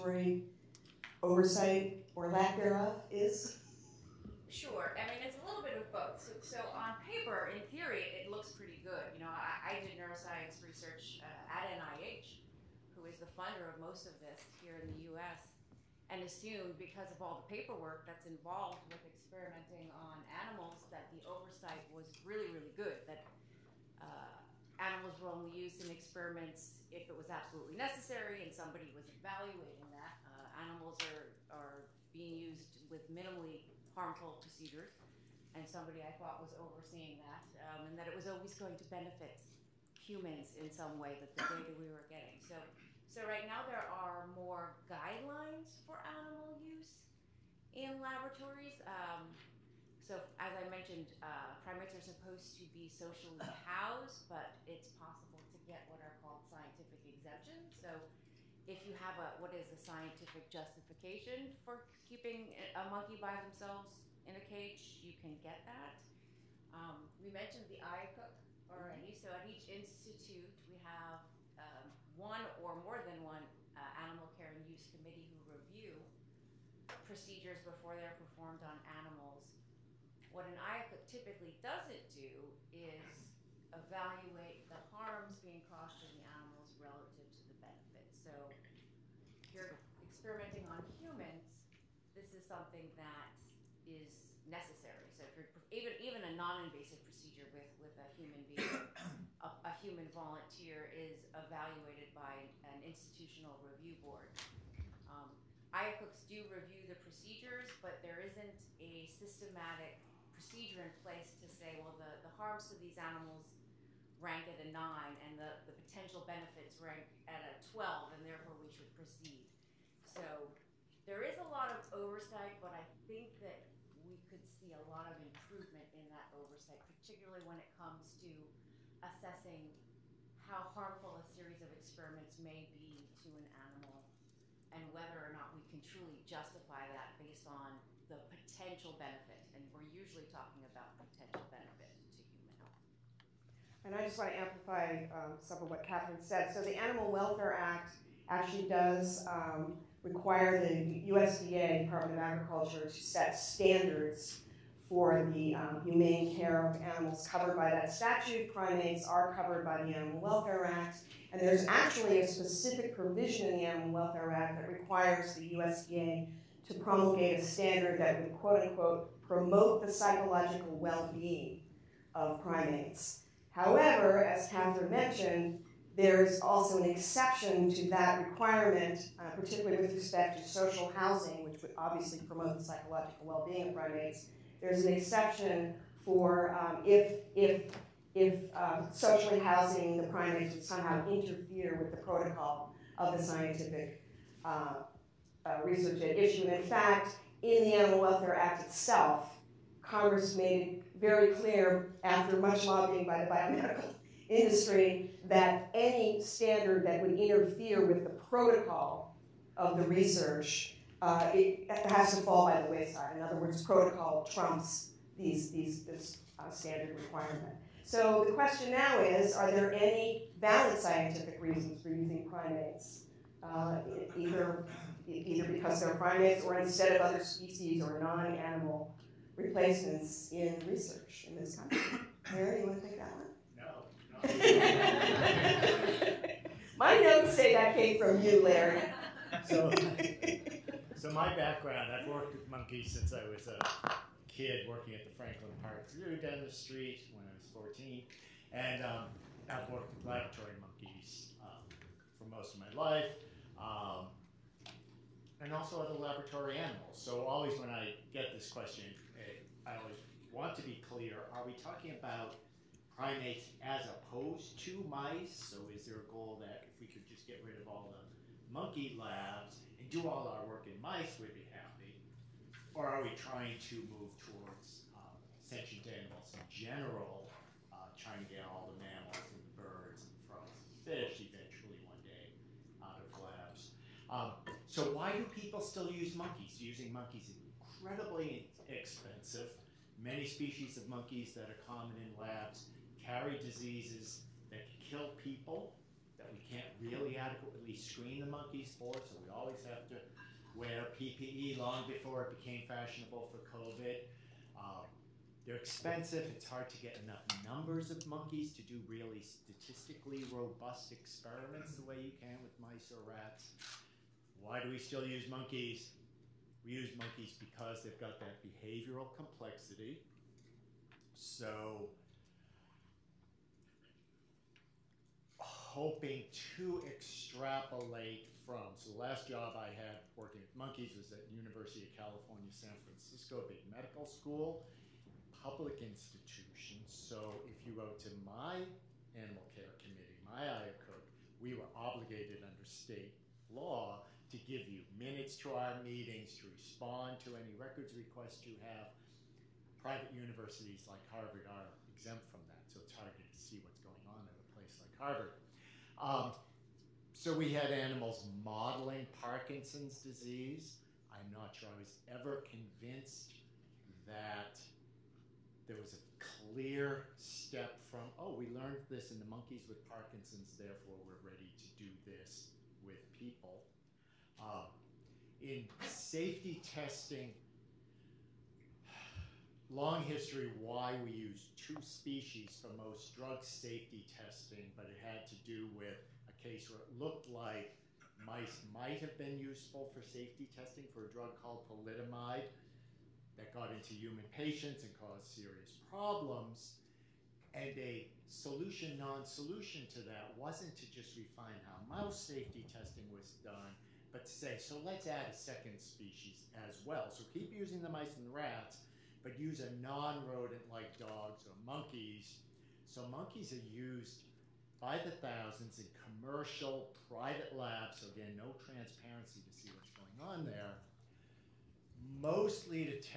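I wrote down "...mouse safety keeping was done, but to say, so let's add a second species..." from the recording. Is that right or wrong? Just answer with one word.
wrong.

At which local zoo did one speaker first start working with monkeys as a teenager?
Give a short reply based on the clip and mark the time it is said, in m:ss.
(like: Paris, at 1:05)
Franklin Park Zoo, at 4:05.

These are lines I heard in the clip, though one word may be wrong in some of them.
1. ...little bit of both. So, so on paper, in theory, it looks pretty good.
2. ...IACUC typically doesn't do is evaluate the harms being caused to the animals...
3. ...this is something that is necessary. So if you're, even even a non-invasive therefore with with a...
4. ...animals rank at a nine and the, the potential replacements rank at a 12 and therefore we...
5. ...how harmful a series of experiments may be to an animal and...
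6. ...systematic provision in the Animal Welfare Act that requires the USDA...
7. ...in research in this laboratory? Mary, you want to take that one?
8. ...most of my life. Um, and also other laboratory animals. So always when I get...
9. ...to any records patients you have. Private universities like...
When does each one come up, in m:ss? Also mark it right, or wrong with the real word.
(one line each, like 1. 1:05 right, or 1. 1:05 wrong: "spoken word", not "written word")
1. 0:05 right
2. 1:20 right
3. 1:32 wrong: "procedure", not "therefore"
4. 1:52 wrong: "benefits", not "replacements"
5. 2:10 right
6. 2:42 wrong: "specific", not "systematic"
7. 3:50 wrong: "country", not "laboratory"
8. 4:12 right
9. 5:47 wrong: "requests", not "patients".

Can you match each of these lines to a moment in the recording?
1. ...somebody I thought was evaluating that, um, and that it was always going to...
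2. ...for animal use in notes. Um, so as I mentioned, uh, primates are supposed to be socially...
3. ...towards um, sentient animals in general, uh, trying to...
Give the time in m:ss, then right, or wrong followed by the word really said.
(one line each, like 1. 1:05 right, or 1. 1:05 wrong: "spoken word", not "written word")
1. 0:35 wrong: "overseeing", not "evaluating"
2. 0:45 wrong: "laboratories", not "notes"
3. 4:34 right.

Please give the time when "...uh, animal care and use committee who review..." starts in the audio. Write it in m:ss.
1:13.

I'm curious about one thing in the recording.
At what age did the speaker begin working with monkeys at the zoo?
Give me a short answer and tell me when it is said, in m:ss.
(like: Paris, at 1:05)
14, at 4:07.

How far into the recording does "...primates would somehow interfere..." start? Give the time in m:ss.
3:10.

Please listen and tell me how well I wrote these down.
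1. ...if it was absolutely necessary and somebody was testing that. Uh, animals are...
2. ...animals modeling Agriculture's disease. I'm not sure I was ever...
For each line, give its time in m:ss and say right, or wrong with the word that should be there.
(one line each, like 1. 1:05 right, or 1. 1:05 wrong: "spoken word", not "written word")
1. 0:26 wrong: "evaluating", not "testing"
2. 5:57 wrong: "Parkinson", not "Agriculture".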